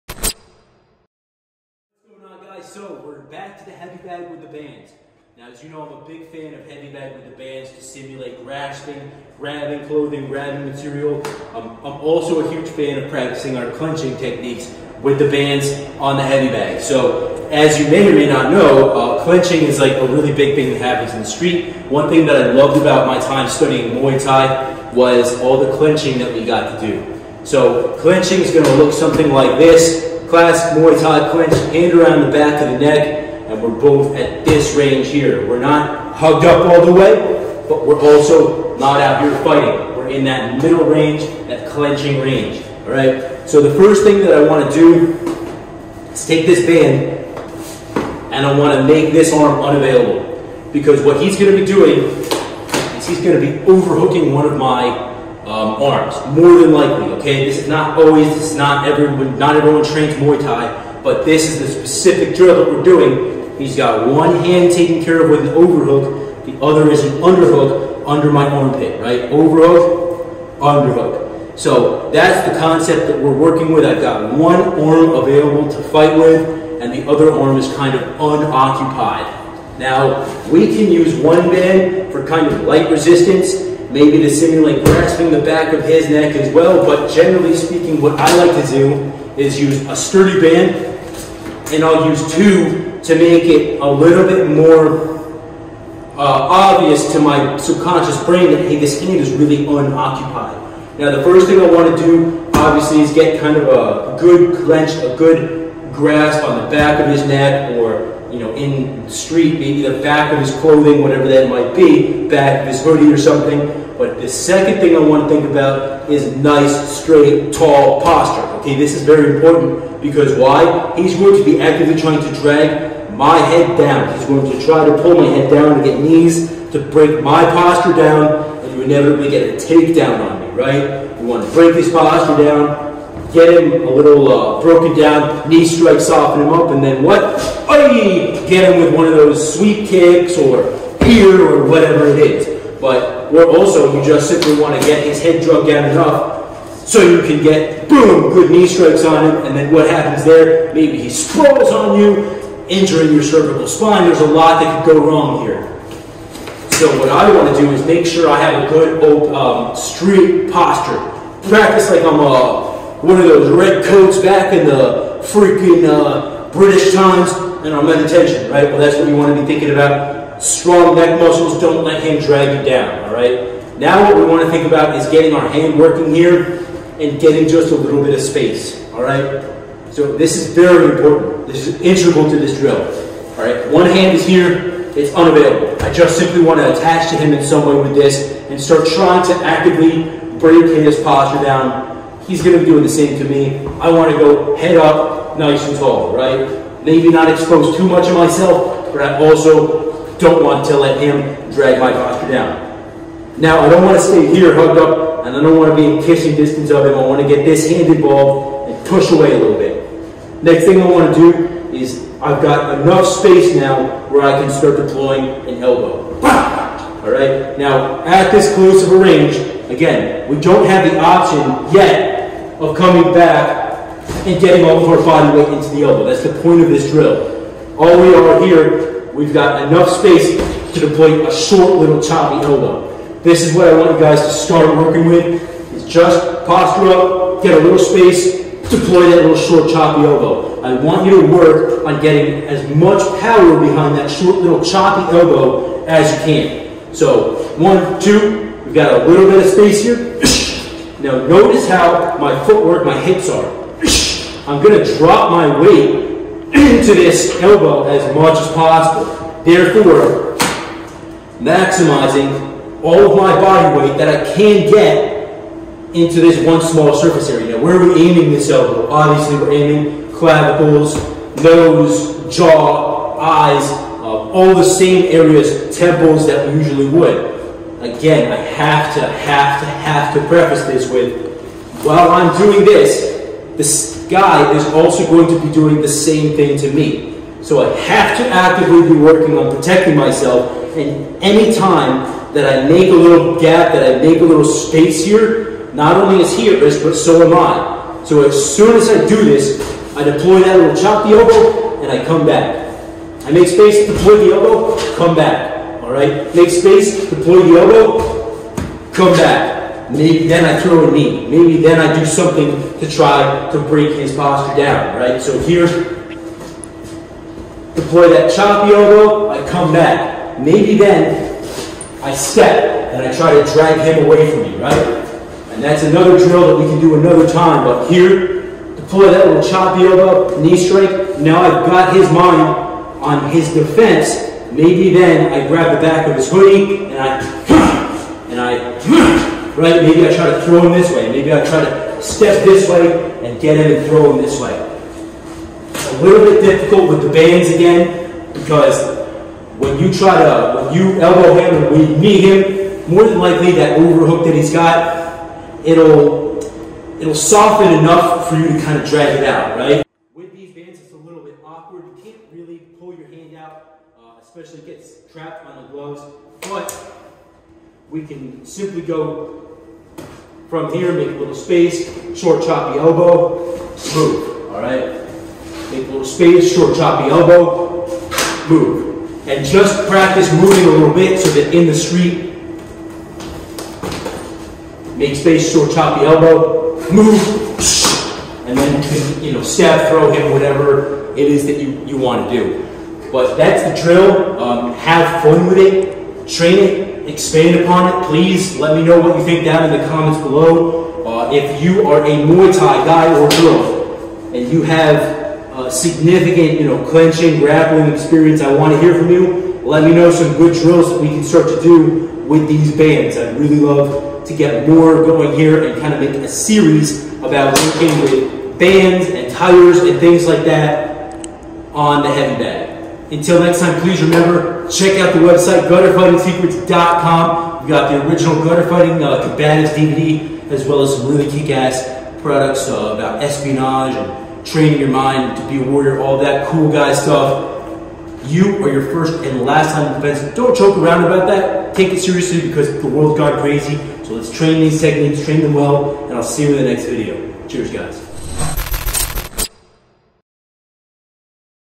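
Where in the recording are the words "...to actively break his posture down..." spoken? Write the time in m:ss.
3:09.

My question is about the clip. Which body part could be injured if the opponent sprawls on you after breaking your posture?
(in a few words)
cervical spine.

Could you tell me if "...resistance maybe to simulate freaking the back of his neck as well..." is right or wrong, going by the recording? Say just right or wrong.
wrong.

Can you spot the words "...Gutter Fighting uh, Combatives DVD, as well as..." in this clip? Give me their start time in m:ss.
7:08.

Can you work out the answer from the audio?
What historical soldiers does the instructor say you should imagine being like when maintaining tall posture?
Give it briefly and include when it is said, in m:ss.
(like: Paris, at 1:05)
red coats, at 2:43.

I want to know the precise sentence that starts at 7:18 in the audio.
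You are your first and last time in defense.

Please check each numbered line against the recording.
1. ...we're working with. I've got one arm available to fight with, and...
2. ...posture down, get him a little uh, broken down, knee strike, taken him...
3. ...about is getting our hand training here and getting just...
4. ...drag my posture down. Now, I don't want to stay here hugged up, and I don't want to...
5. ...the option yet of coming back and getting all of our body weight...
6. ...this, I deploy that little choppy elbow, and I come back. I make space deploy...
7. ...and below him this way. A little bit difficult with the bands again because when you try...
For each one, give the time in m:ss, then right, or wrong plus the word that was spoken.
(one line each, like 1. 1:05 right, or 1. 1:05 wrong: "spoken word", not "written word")
1. 1:13 right
2. 2:11 wrong: "soften", not "taken"
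3. 2:54 wrong: "working", not "training"
4. 3:21 right
5. 3:40 right
6. 4:59 right
7. 5:43 wrong: "throw", not "below".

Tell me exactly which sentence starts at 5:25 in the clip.
And that's another drill that we can do another time, but here, deploy that little choppy elbow, knee strike.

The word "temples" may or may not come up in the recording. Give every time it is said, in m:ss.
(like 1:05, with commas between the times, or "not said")
4:35.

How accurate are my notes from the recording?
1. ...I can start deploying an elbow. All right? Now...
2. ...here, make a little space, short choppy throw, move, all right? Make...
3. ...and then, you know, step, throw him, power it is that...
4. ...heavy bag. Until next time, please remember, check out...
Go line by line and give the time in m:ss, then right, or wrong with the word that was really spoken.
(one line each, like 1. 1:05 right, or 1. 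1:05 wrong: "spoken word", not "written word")
1. 3:34 right
2. 6:10 wrong: "elbow", not "throw"
3. 6:28 wrong: "whatever", not "power"
4. 7:02 right.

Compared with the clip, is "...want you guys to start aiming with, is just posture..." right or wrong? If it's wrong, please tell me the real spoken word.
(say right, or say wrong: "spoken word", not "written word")
wrong: "working", not "aiming".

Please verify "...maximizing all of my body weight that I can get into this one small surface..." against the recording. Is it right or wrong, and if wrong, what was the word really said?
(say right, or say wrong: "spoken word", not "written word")
right.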